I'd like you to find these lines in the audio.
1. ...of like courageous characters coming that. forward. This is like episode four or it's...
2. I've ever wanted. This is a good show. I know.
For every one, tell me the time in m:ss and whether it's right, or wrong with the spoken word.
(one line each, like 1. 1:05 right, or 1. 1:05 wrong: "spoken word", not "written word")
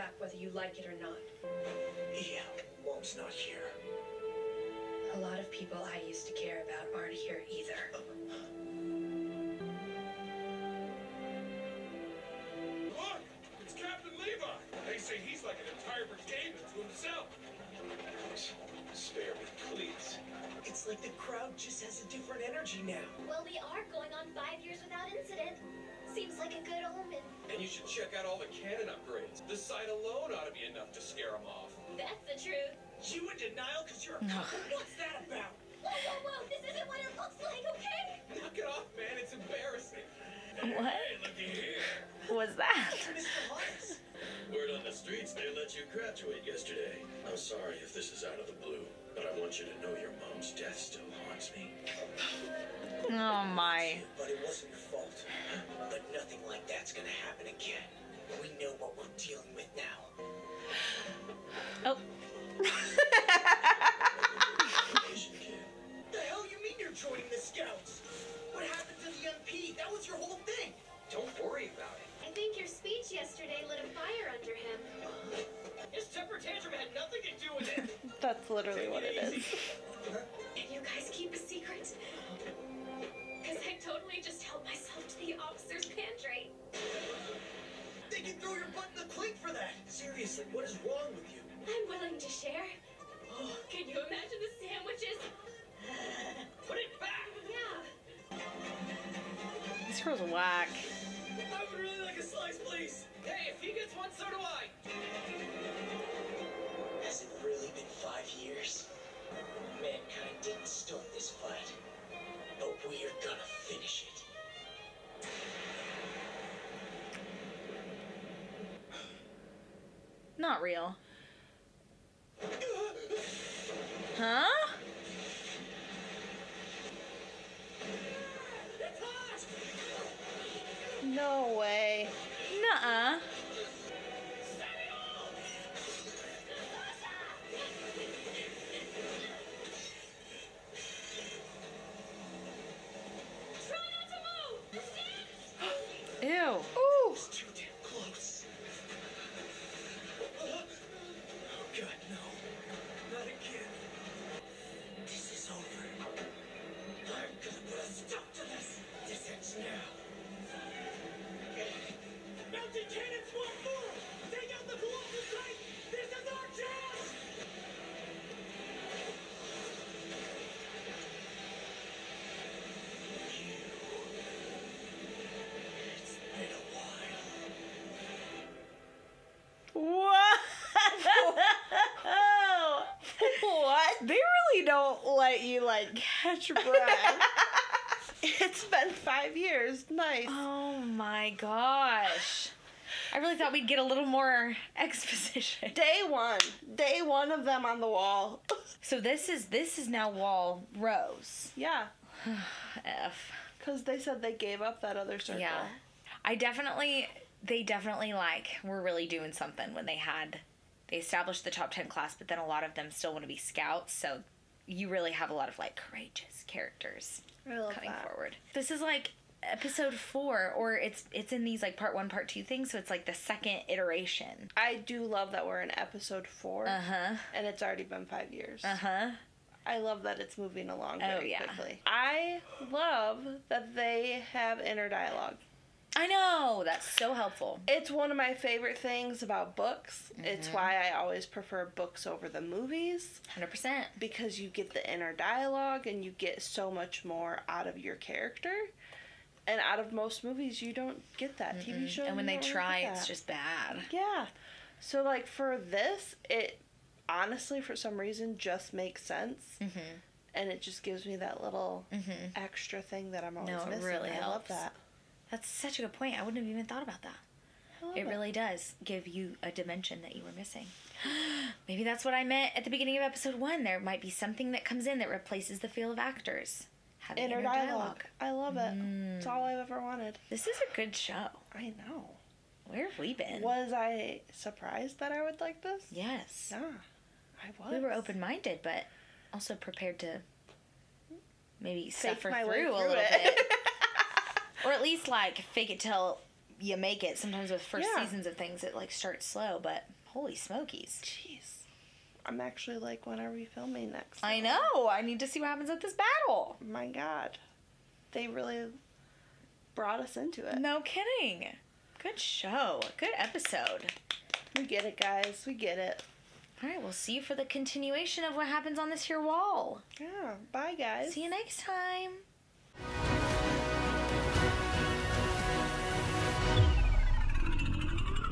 1. 3:35 right
2. 4:39 right.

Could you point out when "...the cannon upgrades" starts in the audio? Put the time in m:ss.
0:28.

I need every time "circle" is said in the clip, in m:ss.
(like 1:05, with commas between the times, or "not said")
3:25.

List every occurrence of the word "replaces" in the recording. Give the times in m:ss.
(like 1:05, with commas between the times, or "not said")
4:35.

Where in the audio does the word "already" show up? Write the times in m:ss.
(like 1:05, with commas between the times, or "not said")
3:47.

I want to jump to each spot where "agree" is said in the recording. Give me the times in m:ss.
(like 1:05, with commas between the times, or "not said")
not said.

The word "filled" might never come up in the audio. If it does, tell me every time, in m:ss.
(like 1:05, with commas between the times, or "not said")
not said.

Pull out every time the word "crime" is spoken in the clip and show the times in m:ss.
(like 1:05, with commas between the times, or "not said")
not said.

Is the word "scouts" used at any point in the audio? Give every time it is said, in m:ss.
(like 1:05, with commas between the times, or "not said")
1:07, 3:33.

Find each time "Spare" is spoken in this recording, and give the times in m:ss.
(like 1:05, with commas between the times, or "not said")
0:18.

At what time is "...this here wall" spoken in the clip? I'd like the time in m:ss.
5:18.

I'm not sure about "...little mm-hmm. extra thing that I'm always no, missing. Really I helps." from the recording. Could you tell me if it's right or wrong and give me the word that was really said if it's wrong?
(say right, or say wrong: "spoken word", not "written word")
right.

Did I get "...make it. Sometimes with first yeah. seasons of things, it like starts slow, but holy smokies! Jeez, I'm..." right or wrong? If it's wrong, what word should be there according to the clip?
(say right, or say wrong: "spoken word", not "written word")
right.